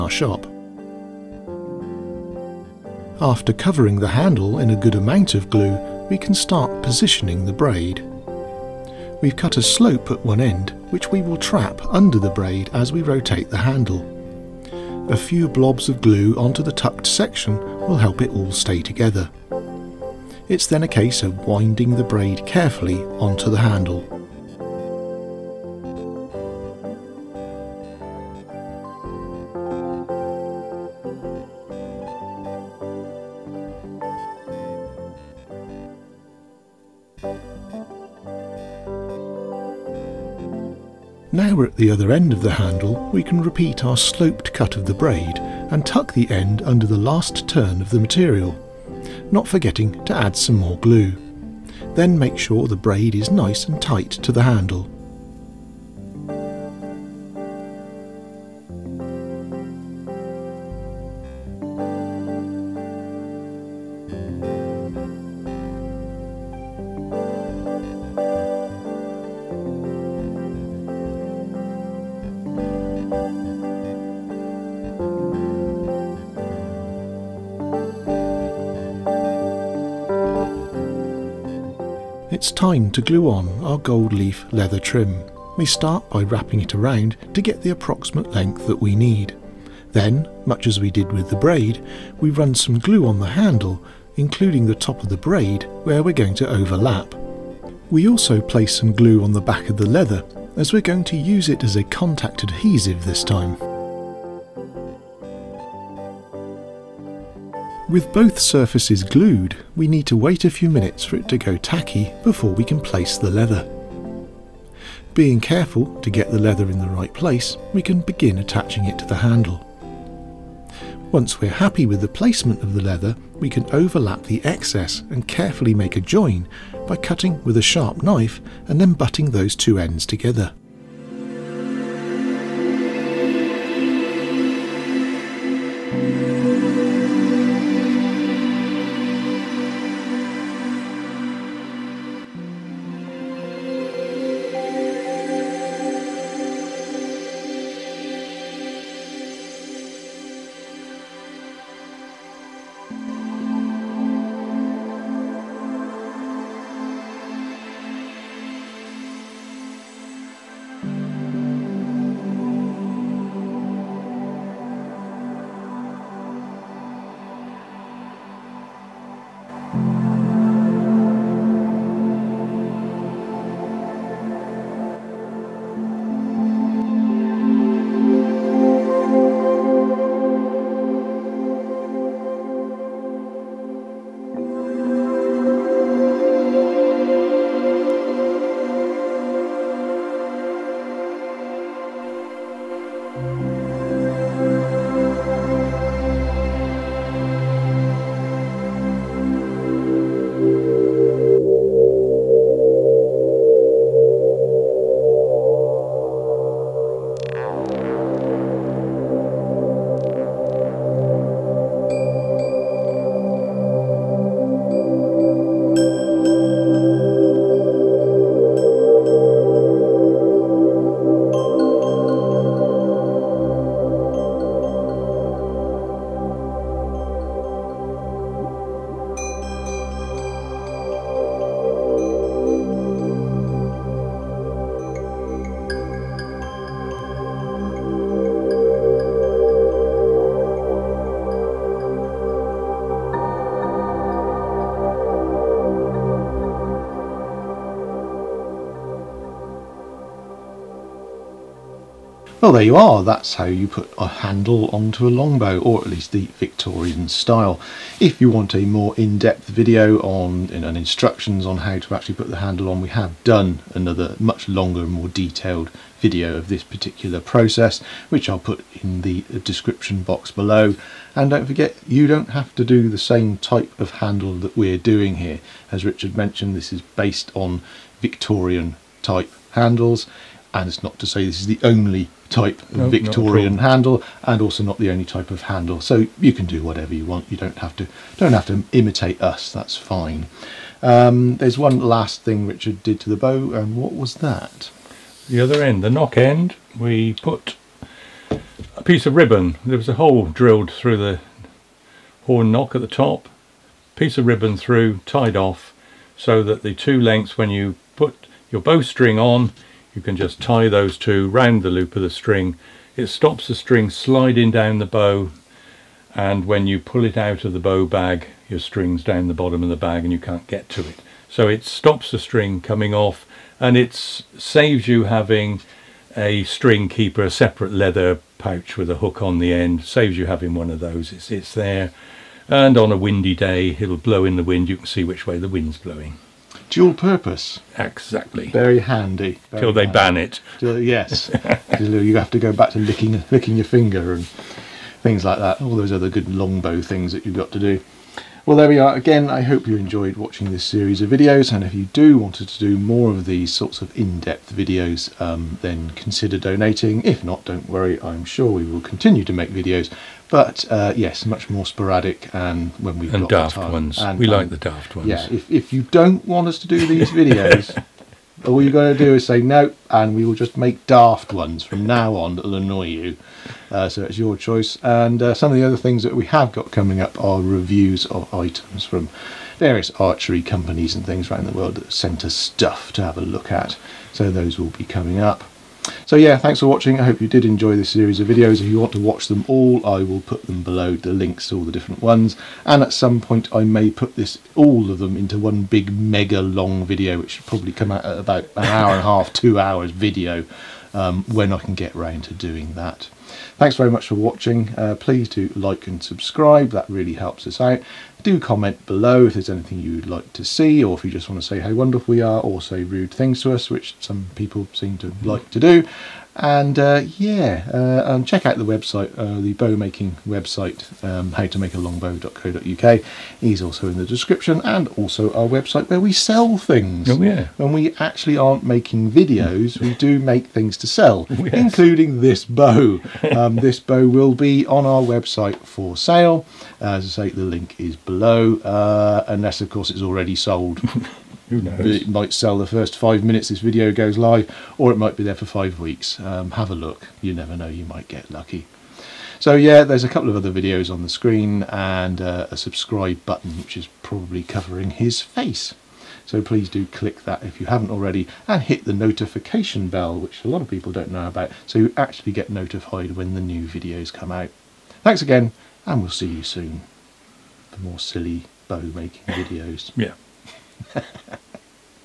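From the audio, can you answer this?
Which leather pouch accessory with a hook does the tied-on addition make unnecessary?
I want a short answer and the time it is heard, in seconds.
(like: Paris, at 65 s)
String keeper, at 326 s.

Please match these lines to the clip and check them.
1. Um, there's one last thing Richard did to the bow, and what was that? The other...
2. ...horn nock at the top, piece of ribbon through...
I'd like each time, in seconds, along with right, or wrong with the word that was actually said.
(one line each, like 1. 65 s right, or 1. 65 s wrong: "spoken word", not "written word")
1. 290 s right
2. 302 s right.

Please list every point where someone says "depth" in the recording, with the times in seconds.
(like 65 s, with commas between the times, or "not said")
258 s, 353 s.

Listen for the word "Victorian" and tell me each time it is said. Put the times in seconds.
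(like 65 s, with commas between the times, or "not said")
256 s, 278 s, 282 s.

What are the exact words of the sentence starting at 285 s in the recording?
So you can do whatever you want.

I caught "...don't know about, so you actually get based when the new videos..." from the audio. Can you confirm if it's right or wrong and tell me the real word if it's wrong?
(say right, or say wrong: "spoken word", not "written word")
wrong: "notified", not "based".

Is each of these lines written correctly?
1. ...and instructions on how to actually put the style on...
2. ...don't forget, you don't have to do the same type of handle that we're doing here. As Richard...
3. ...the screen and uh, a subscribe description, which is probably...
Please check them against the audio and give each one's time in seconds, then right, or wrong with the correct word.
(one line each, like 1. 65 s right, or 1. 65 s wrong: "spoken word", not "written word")
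1. 260 s wrong: "handle", not "style"
2. 271 s right
3. 451 s wrong: "button", not "description".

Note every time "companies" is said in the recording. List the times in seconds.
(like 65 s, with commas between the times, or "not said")
380 s.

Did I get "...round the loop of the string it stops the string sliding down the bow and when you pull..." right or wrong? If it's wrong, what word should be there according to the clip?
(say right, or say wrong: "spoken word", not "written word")
right.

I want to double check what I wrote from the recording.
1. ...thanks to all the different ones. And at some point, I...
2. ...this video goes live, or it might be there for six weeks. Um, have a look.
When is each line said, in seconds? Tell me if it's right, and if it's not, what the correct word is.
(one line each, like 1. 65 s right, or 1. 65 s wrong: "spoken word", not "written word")
1. 391 s wrong: "links", not "thanks"
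2. 443 s wrong: "five", not "six".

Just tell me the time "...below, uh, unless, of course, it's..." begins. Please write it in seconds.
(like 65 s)
438 s.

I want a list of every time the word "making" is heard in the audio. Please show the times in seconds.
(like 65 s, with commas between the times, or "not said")
419 s, 428 s, 468 s.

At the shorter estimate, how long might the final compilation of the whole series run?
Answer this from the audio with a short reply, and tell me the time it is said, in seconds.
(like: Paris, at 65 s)
An hour and a half, at 398 s.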